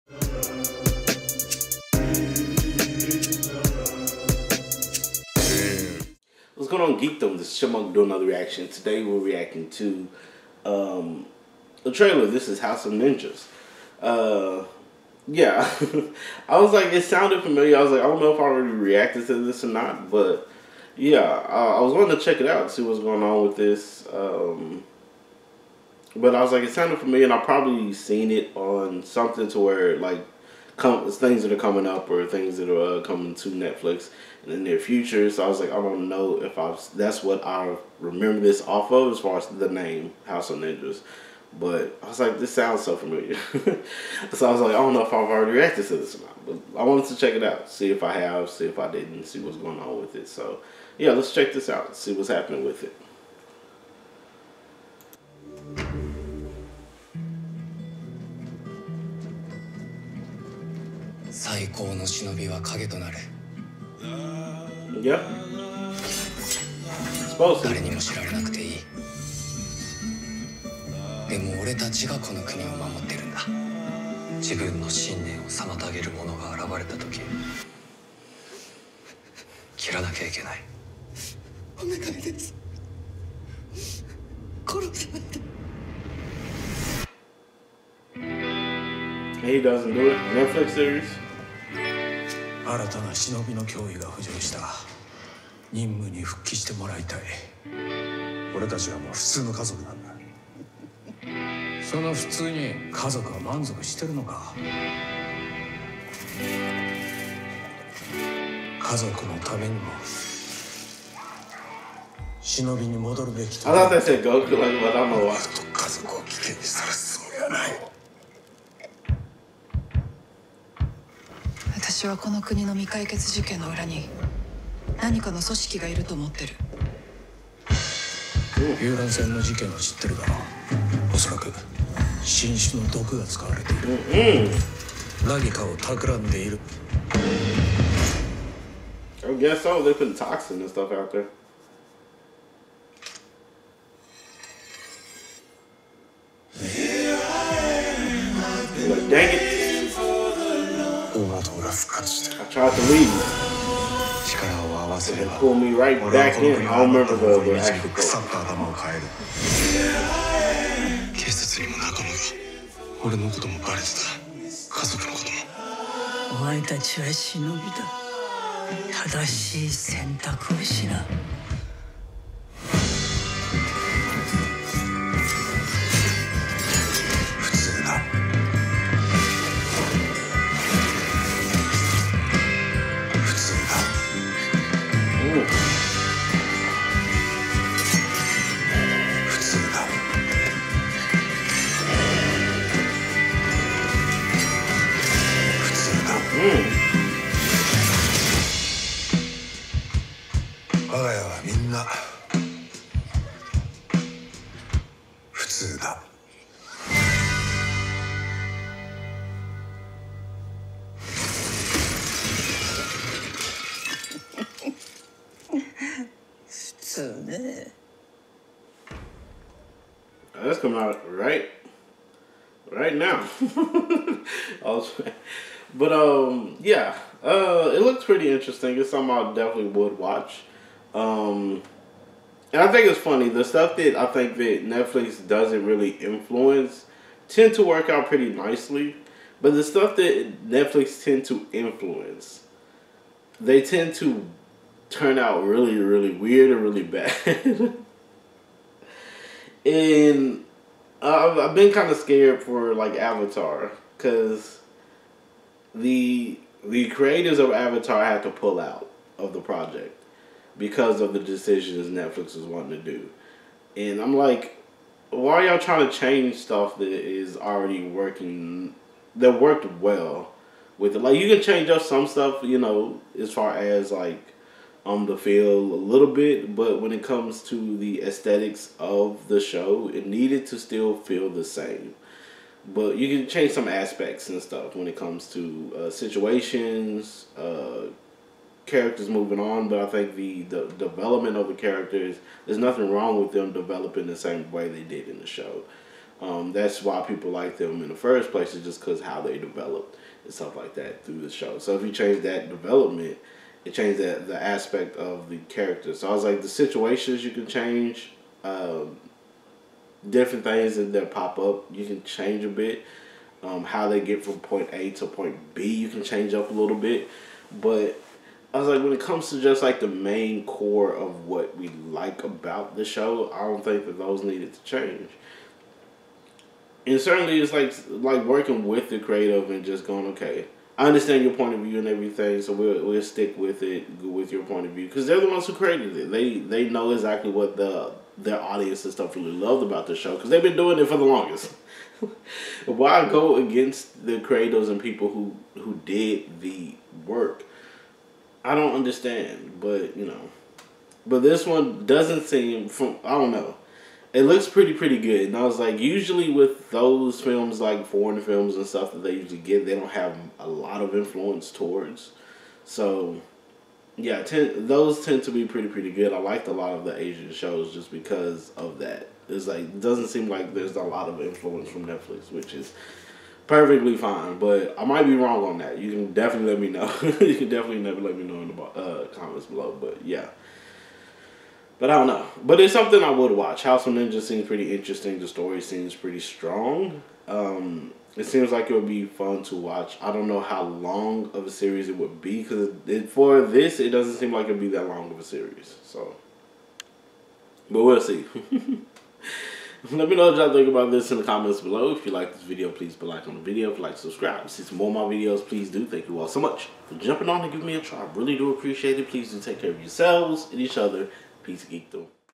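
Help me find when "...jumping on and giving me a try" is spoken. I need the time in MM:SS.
06:46.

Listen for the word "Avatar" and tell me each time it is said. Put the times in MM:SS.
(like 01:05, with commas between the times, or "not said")
04:12, 04:17.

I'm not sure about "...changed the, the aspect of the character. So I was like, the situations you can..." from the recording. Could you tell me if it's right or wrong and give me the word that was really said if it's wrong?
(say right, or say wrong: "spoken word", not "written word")
right.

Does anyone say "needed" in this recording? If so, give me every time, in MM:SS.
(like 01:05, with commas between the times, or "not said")
04:40, 05:24.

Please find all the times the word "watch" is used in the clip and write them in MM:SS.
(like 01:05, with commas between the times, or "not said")
03:49, 06:23, 06:29.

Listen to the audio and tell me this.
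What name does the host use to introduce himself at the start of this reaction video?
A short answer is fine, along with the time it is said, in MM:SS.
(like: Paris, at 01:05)
Chipmunk, at 00:07.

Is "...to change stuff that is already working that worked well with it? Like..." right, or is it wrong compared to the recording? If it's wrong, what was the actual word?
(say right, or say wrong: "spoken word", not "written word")
right.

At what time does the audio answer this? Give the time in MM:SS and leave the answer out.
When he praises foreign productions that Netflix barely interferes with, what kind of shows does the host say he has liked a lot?
06:06.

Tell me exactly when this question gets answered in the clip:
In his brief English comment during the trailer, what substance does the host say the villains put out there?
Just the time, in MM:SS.
02:20.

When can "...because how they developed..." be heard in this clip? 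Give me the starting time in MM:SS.
04:58.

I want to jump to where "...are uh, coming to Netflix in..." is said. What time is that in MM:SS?
00:32.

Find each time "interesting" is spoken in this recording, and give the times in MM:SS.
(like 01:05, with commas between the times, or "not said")
03:48, 06:24.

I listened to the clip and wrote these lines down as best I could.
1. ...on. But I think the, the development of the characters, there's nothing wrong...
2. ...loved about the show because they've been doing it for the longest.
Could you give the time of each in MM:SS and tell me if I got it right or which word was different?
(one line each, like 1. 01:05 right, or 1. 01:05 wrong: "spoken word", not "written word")
1. 04:49 right
2. 05:39 right.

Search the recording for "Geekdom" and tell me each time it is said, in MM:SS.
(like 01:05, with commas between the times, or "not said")
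00:07, 06:51.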